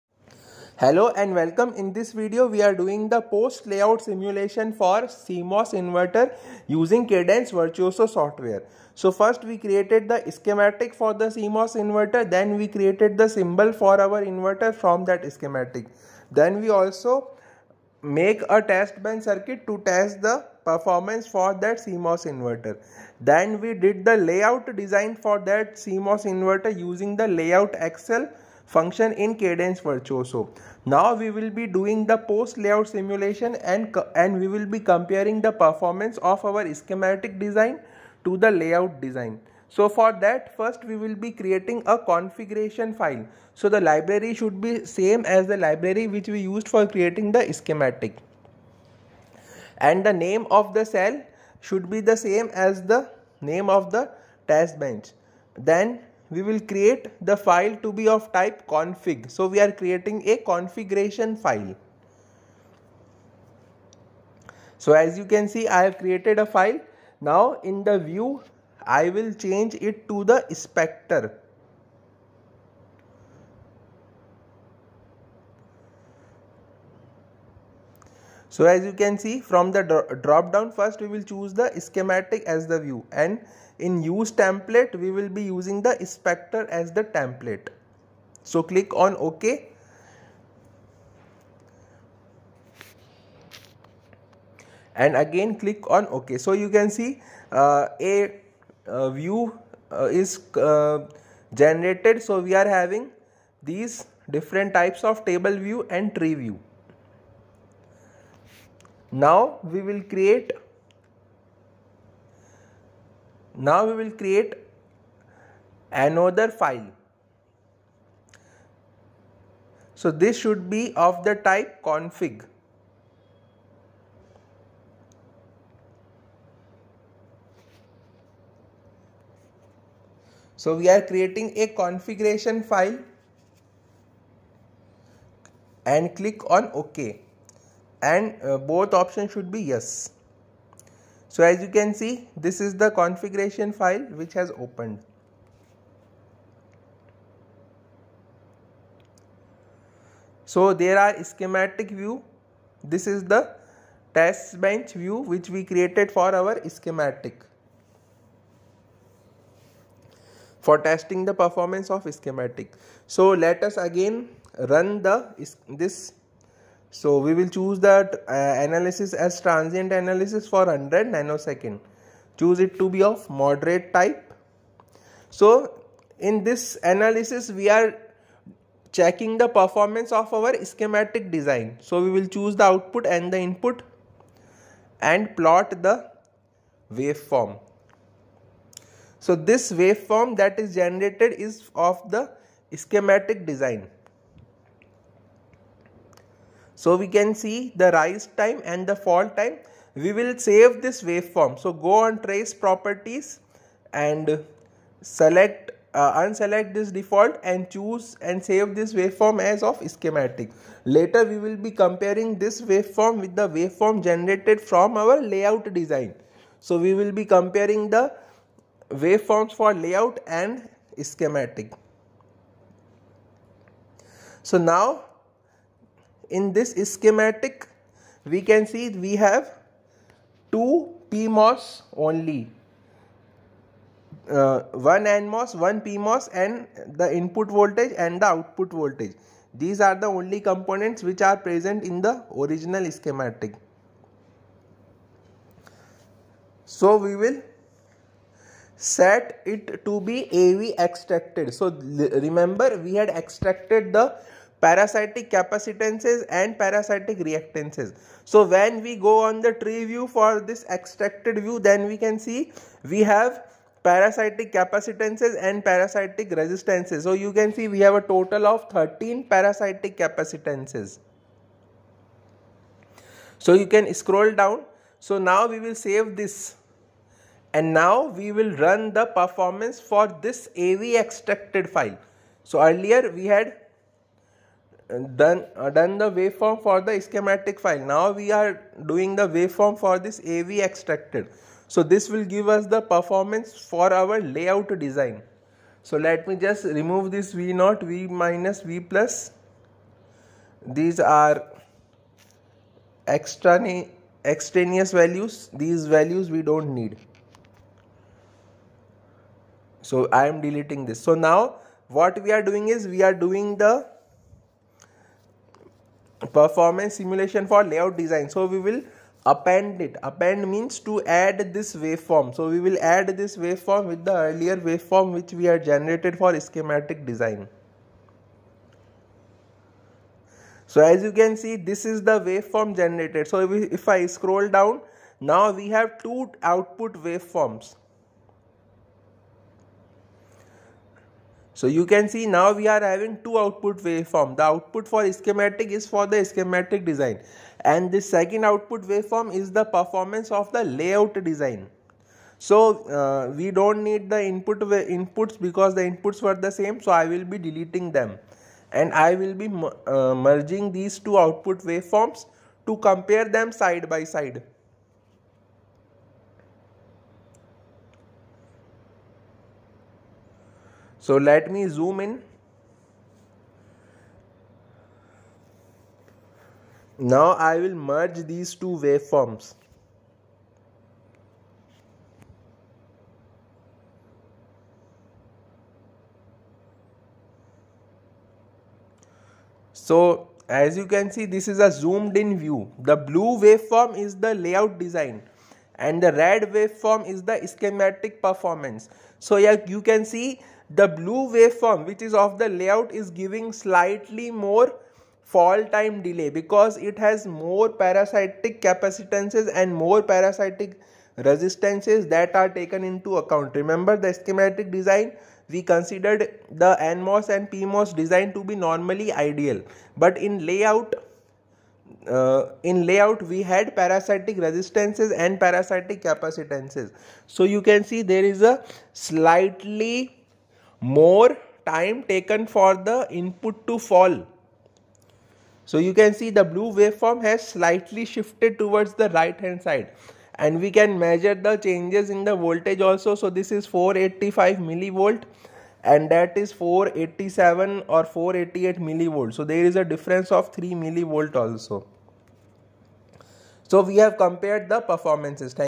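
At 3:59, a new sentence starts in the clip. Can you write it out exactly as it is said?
These are the only components which are present in the original schematic.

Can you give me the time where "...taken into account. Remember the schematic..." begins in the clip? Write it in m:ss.
6:52.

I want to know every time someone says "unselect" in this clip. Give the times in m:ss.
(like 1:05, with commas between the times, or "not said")
3:26.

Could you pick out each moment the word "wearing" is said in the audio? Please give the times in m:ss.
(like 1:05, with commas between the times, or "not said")
not said.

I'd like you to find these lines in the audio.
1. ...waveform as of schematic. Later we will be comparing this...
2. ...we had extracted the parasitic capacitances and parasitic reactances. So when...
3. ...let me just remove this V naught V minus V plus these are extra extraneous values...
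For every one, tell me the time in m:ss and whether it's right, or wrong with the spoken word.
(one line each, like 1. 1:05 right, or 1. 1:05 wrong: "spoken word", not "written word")
1. 3:28 right
2. 4:12 right
3. 4:55 right.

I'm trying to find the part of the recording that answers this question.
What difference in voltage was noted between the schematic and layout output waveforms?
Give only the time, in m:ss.
7:30.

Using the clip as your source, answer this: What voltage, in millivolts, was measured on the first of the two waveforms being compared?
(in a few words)
485 millivolts.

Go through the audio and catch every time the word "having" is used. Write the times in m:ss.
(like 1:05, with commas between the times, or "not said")
1:42, 5:42.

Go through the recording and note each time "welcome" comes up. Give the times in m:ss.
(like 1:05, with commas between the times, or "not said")
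0:01.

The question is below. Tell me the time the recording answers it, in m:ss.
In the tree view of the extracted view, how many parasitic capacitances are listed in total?
4:28.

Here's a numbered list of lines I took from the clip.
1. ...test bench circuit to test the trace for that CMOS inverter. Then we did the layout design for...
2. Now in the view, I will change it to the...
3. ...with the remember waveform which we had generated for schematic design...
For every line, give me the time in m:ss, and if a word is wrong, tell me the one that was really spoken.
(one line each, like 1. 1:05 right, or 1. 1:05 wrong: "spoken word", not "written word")
1. 0:18 wrong: "performance", not "trace"
2. 1:07 right
3. 5:23 wrong: "earlier", not "remember".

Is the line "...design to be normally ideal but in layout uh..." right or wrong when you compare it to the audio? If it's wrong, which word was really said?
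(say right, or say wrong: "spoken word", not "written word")
right.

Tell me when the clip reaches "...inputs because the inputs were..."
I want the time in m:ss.
5:54.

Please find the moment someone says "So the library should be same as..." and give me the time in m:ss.
0:43.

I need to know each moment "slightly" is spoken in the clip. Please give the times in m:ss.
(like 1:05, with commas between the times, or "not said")
6:43, 7:08, 7:17.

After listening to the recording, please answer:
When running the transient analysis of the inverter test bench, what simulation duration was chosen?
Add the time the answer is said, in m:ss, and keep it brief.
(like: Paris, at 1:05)
100 nanoseconds, at 2:50.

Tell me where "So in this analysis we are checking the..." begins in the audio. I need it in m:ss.
2:55.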